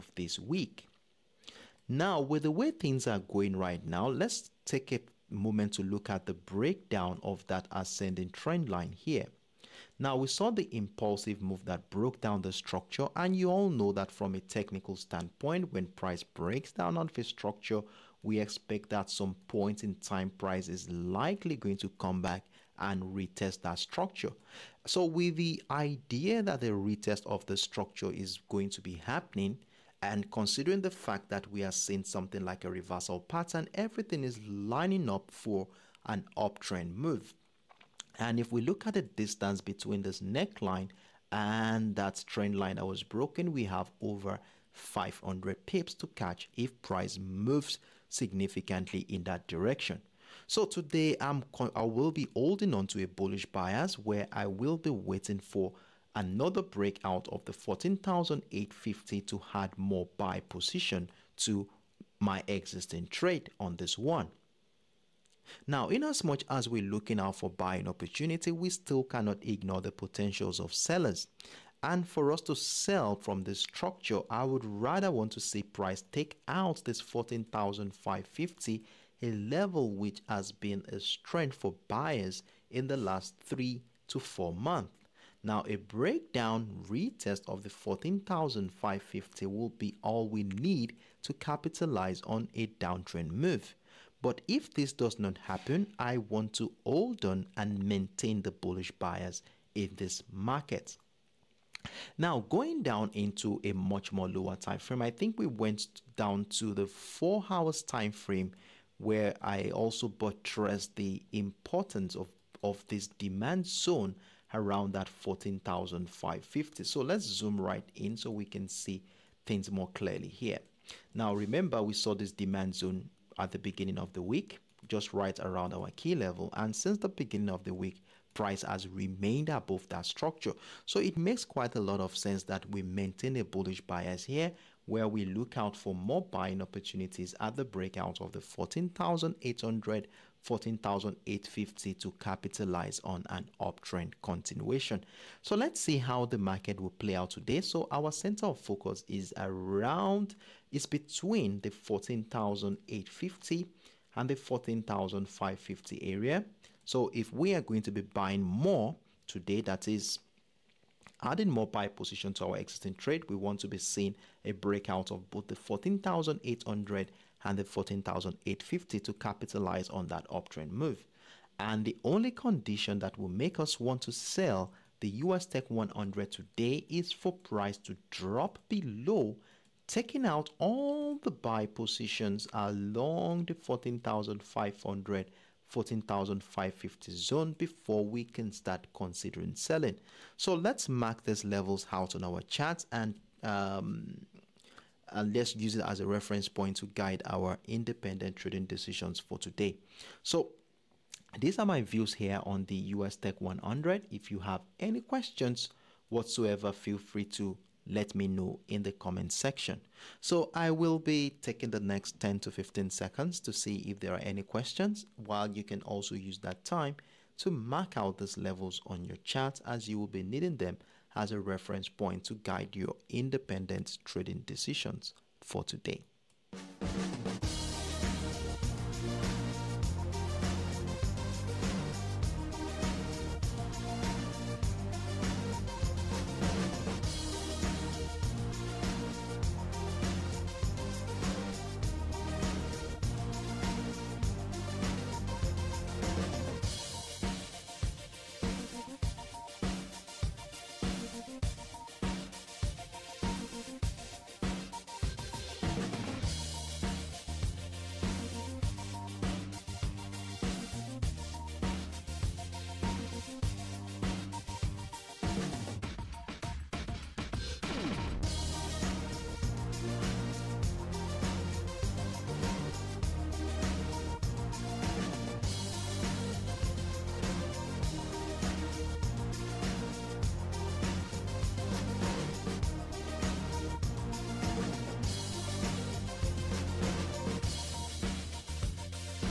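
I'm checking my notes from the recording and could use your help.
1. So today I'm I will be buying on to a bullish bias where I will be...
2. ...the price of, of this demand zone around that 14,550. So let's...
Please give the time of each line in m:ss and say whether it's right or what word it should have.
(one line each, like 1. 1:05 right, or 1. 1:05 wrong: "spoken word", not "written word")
1. 0:50 wrong: "holding", not "buying"
2. 1:50 wrong: "importance", not "price".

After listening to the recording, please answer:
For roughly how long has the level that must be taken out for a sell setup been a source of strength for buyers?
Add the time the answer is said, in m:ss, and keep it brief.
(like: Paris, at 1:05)
3 to 4 months, at 1:23.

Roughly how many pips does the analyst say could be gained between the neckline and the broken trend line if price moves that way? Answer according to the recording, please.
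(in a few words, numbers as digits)
500.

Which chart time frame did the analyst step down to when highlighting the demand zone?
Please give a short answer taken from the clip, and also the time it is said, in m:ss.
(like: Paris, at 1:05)
4 hours, at 1:46.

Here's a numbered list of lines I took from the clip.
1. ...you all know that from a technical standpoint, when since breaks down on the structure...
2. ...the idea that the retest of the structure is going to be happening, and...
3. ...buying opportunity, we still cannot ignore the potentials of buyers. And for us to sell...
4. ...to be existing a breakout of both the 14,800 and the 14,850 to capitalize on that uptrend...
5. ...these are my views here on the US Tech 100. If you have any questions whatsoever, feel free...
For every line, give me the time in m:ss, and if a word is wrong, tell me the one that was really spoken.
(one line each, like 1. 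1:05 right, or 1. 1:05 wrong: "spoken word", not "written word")
1. 0:13 wrong: "price", not "since"
2. 0:25 right
3. 1:07 wrong: "sellers", not "buyers"
4. 2:43 wrong: "seeing", not "existing"
5. 3:21 right.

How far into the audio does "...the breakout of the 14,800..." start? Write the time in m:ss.
2:17.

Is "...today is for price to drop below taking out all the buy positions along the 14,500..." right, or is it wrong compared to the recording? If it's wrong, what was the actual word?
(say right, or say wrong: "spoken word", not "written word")
right.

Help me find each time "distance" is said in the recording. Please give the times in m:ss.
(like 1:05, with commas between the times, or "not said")
0:39.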